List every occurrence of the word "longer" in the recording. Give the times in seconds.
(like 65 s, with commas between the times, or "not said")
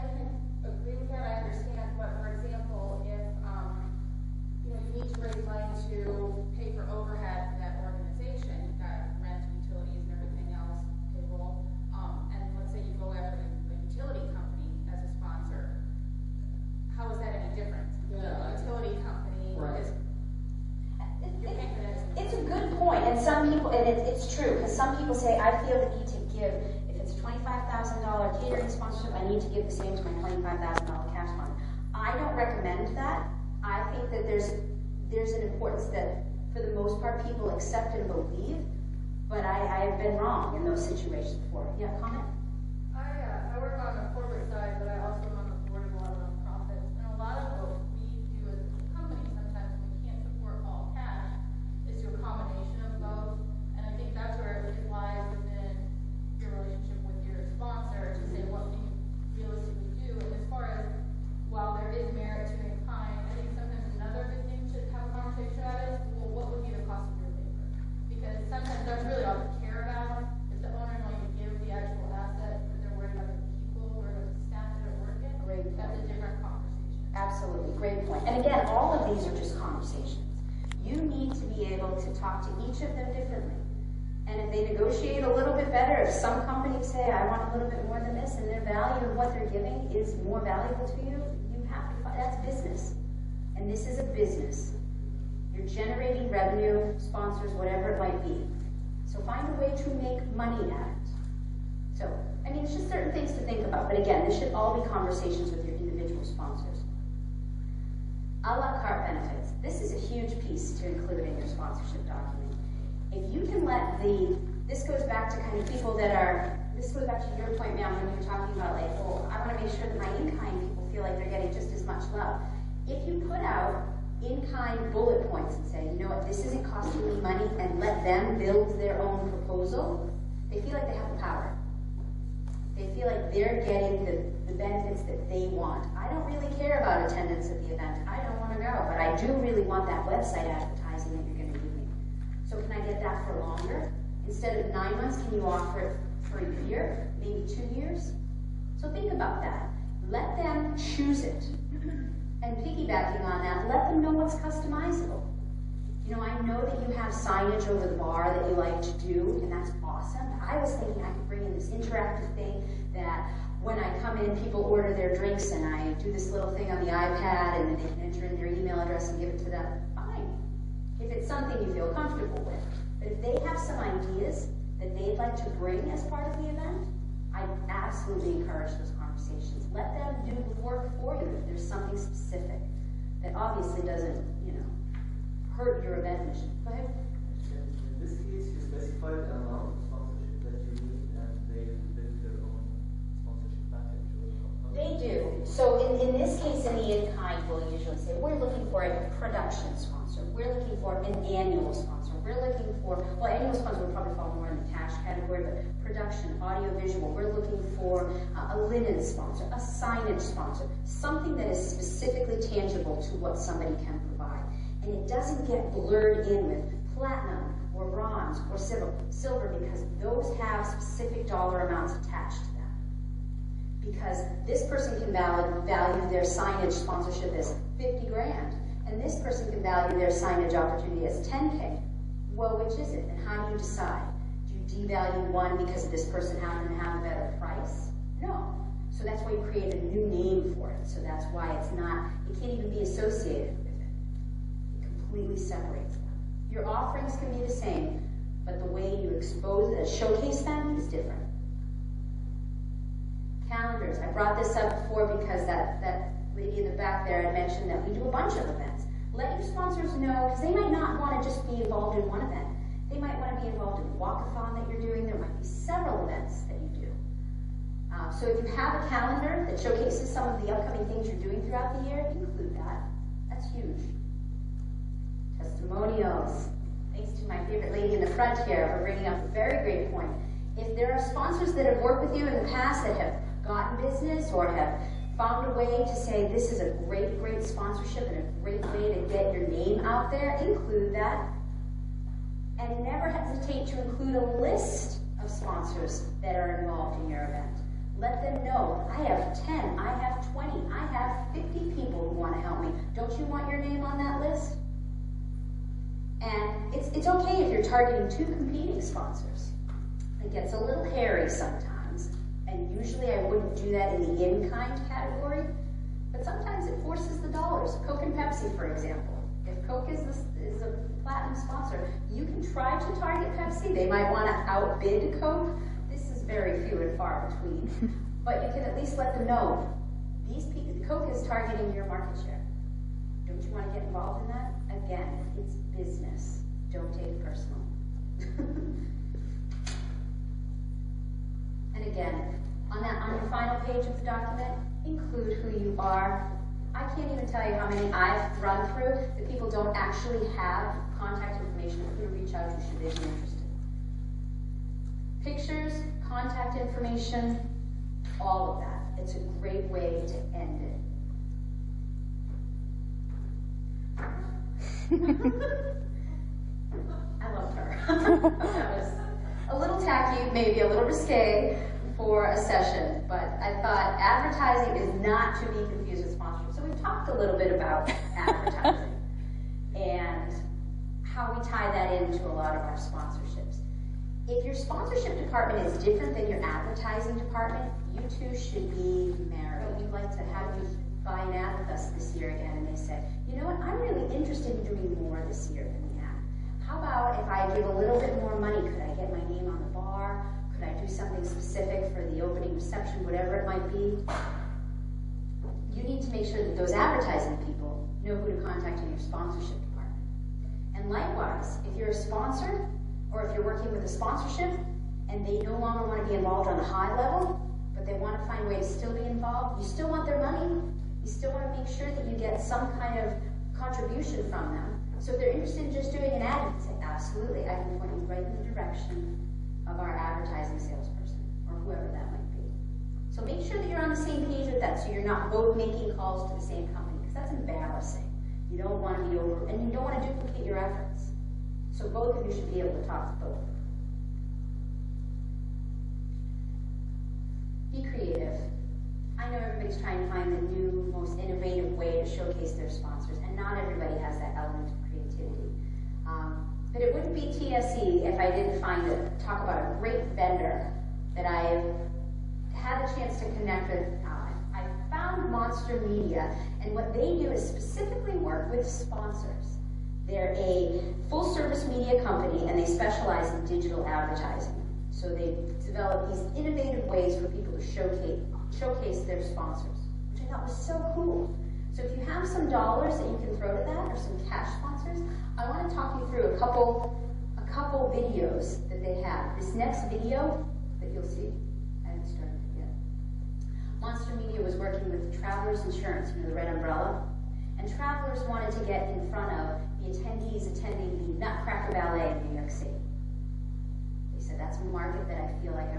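143 s, 415 s.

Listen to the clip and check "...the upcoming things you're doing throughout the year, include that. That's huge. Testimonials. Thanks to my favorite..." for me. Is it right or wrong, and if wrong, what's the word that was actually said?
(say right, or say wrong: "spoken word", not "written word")
right.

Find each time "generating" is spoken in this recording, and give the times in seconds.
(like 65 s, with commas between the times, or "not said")
95 s.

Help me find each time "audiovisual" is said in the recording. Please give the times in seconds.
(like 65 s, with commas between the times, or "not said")
206 s.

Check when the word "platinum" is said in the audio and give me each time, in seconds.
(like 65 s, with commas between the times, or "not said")
216 s, 321 s.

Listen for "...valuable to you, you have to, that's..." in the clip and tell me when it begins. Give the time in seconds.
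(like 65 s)
90 s.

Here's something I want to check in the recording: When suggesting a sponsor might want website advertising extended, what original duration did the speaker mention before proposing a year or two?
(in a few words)
9 months.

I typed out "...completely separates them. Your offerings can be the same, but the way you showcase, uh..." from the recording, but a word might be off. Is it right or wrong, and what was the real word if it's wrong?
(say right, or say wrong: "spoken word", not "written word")
wrong: "expose", not "showcase".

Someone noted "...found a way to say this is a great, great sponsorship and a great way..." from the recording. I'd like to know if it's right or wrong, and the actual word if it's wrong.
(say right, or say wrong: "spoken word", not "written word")
right.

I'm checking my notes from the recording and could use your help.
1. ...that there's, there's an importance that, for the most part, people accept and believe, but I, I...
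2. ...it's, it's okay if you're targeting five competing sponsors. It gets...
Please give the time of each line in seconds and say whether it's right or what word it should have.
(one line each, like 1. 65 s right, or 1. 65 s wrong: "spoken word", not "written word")
1. 34 s right
2. 306 s wrong: "two", not "five".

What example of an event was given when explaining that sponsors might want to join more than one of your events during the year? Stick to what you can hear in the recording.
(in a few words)
Walkathon.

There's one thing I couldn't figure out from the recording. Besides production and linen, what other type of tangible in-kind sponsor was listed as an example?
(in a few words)
Signage sponsor.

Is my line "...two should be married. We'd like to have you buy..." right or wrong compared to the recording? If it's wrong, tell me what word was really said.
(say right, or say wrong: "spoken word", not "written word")
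right.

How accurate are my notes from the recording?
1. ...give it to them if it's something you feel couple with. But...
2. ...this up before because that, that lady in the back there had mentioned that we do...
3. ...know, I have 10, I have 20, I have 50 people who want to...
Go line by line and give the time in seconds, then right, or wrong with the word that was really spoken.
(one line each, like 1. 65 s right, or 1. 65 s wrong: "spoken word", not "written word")
1. 169 s wrong: "comfortable", not "couple"
2. 254 s right
3. 298 s right.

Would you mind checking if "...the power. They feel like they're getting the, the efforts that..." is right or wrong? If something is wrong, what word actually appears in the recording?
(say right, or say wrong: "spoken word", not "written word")
wrong: "benefits", not "efforts".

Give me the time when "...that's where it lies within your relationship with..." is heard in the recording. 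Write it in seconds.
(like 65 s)
54 s.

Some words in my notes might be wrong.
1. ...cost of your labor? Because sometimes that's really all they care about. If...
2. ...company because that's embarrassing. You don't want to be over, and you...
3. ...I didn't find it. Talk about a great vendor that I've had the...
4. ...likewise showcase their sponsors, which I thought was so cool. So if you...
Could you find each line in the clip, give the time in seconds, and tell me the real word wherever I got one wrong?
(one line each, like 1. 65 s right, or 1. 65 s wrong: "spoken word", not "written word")
1. 66 s right
2. 436 s right
3. 458 s right
4. 477 s wrong: "showcase", not "likewise".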